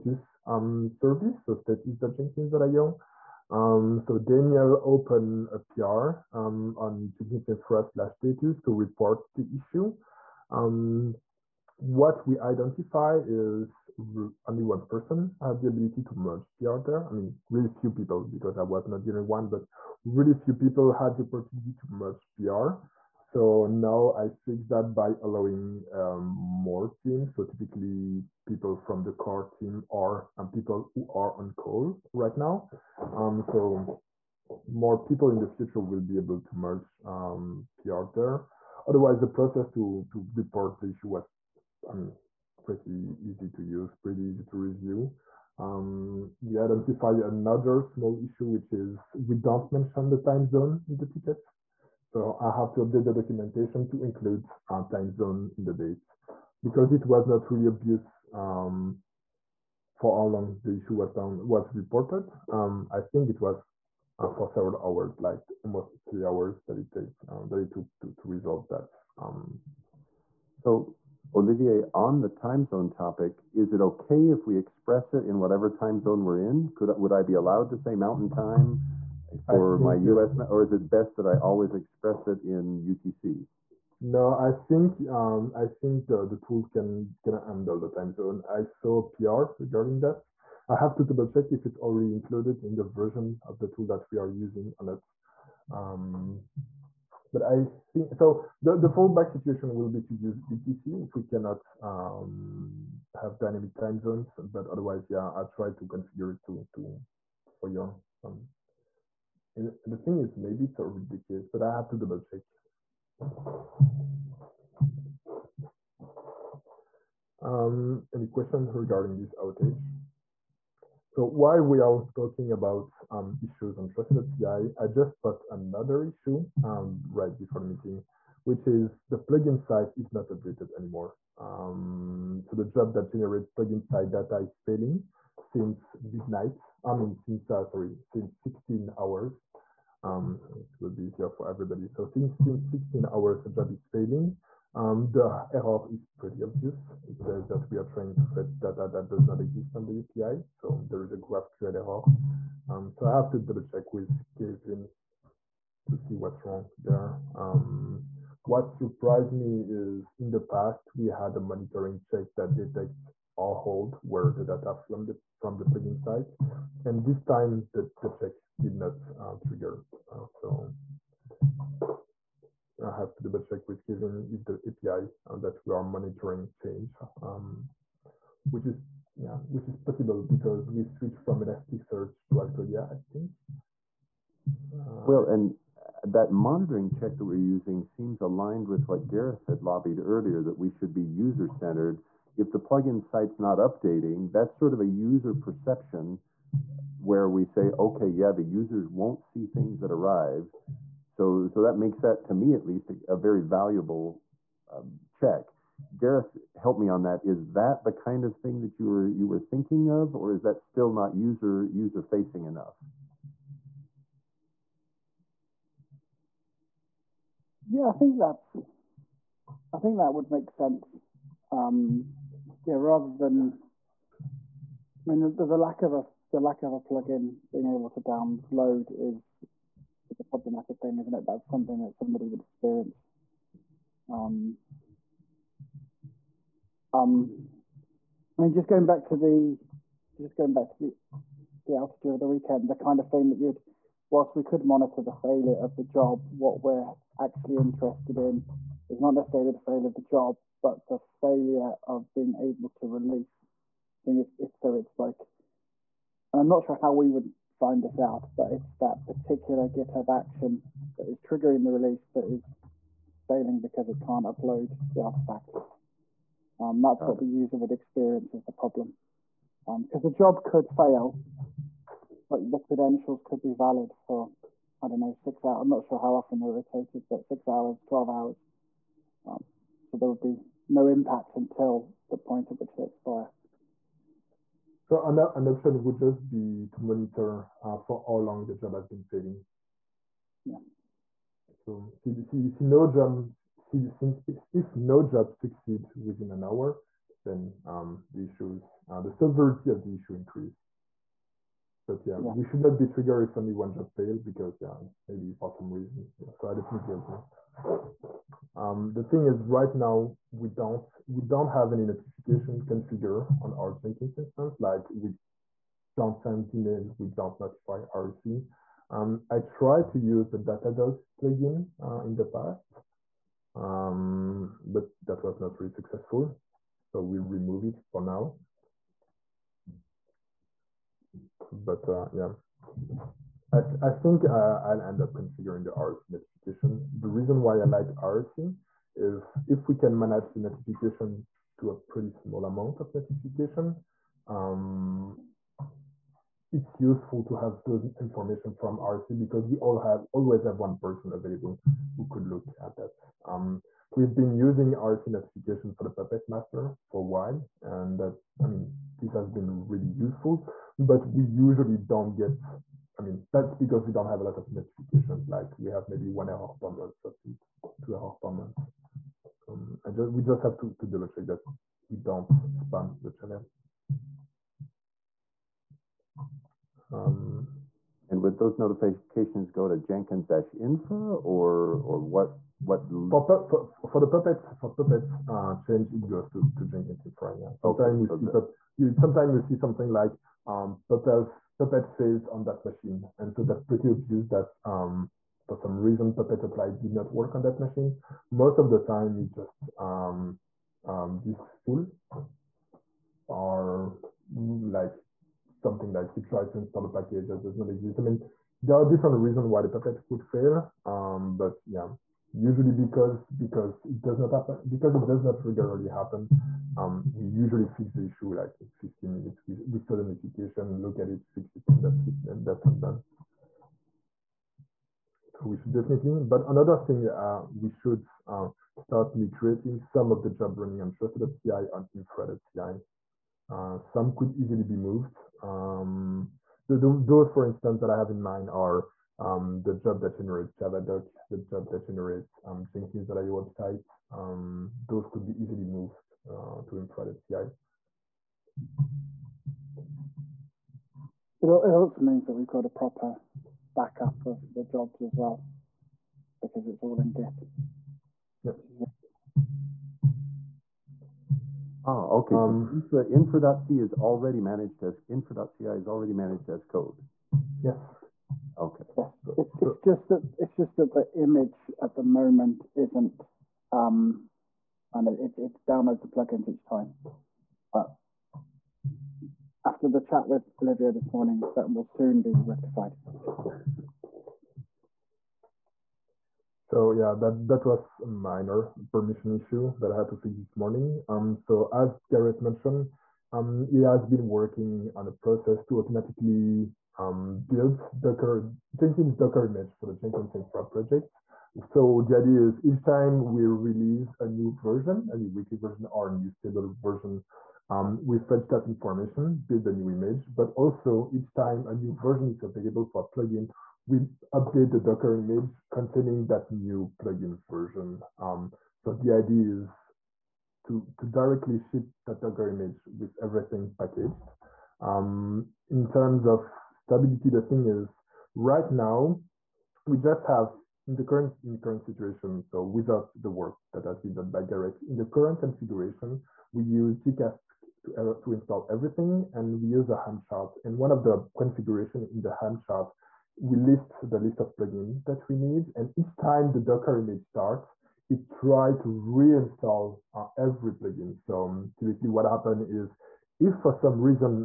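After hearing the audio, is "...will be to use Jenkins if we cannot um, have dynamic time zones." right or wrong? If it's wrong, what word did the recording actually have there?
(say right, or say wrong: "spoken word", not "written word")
wrong: "UTC", not "Jenkins".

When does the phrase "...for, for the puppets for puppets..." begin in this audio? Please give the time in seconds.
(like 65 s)
383 s.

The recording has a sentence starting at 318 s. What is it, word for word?
Um, I tried to use the Datadog plugin uh, in the past, um, but that was not really successful.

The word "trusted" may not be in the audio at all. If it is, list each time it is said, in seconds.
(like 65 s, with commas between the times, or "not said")
123 s, 430 s.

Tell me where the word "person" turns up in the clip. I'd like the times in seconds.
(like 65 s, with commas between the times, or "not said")
14 s, 350 s.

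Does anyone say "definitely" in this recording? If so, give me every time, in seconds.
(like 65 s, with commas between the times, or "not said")
306 s, 425 s.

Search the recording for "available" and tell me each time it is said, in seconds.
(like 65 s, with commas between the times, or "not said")
351 s, 512 s.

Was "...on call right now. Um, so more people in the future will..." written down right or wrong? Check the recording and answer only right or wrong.
right.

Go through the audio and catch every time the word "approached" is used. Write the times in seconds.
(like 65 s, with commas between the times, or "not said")
not said.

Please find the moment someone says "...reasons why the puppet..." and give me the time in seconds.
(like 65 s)
409 s.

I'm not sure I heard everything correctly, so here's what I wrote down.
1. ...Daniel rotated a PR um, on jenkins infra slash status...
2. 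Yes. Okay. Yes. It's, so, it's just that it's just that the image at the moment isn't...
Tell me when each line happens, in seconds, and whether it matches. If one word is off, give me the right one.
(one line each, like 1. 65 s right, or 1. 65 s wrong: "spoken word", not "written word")
1. 4 s wrong: "opened", not "rotated"
2. 467 s right.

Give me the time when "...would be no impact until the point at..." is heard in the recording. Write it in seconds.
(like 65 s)
280 s.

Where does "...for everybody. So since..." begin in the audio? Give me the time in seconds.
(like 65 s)
141 s.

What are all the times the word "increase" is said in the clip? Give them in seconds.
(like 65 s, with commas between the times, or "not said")
300 s.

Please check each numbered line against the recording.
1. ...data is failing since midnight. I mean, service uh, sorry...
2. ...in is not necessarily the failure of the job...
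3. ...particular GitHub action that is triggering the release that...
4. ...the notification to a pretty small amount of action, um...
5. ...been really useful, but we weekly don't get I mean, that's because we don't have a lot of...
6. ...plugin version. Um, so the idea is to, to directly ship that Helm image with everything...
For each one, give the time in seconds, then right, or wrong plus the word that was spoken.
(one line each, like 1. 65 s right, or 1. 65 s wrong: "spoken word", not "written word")
1. 134 s wrong: "since", not "service"
2. 248 s right
3. 259 s right
4. 340 s wrong: "notification", not "action"
5. 359 s wrong: "usually", not "weekly"
6. 516 s wrong: "Docker", not "Helm".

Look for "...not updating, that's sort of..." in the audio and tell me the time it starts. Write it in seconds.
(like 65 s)
193 s.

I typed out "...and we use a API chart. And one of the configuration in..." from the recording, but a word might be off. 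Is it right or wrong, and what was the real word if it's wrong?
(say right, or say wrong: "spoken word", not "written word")
wrong: "Helm", not "API".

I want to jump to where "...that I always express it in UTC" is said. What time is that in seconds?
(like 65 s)
81 s.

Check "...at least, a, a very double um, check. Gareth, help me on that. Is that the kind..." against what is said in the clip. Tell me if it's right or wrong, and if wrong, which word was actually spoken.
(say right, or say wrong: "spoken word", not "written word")
wrong: "valuable", not "double".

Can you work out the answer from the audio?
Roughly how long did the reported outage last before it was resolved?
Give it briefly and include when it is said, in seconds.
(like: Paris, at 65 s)
almost 3 hours, at 65 s.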